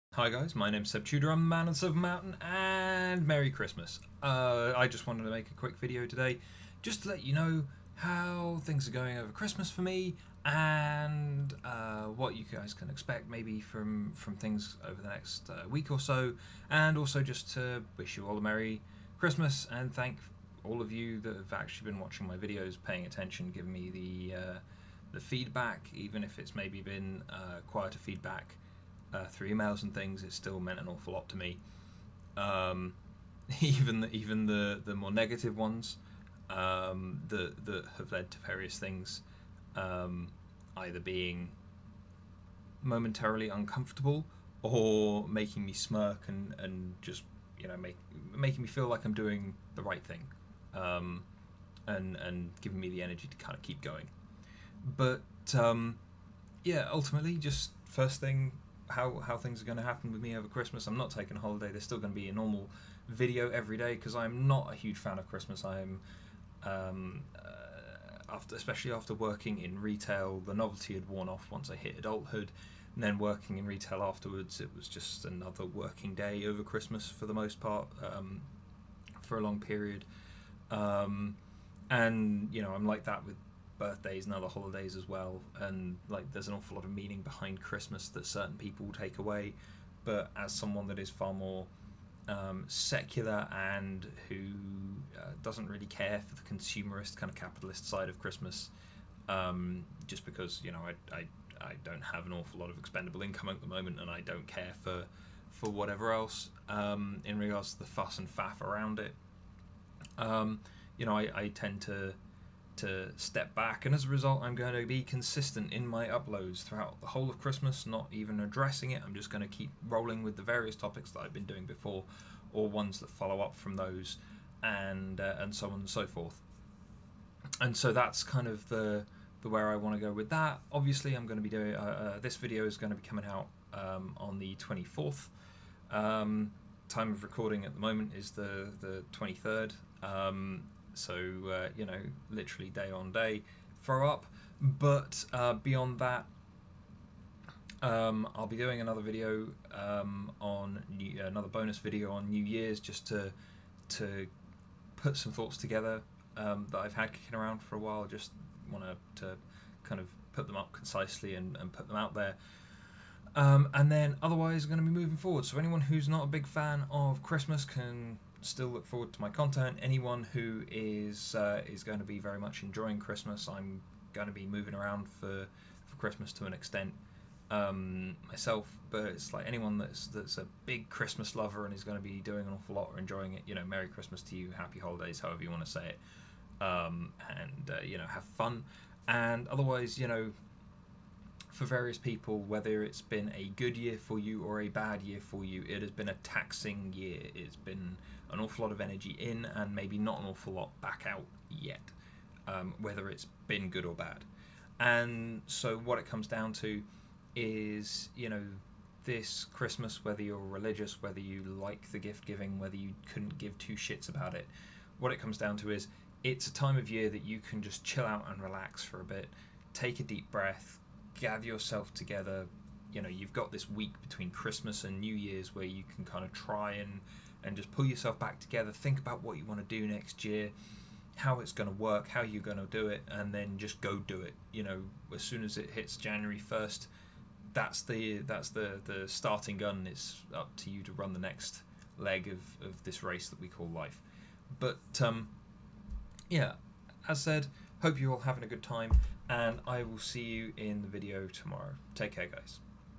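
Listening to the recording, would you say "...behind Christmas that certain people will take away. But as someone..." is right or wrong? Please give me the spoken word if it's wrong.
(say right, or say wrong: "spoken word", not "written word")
right.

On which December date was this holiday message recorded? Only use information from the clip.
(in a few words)
23rd.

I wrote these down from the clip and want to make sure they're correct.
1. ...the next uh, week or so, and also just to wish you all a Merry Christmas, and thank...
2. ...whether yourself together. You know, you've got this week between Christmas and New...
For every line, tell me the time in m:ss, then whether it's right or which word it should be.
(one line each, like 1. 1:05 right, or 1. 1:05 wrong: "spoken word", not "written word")
1. 0:15 right
2. 3:41 wrong: "gather", not "whether".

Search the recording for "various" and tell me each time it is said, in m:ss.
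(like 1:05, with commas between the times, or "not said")
0:38, 2:00, 3:11.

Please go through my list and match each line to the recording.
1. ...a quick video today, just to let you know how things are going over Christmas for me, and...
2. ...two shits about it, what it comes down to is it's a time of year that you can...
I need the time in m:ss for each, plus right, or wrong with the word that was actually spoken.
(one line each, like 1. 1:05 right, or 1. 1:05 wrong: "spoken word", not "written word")
1. 0:05 right
2. 3:33 right.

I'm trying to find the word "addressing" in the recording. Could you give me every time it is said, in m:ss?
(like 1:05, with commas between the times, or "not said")
1:58.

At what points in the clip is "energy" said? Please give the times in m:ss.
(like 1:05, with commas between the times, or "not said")
0:53, 3:18.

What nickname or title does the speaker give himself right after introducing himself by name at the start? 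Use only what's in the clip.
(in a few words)
Man of Silver Mountain.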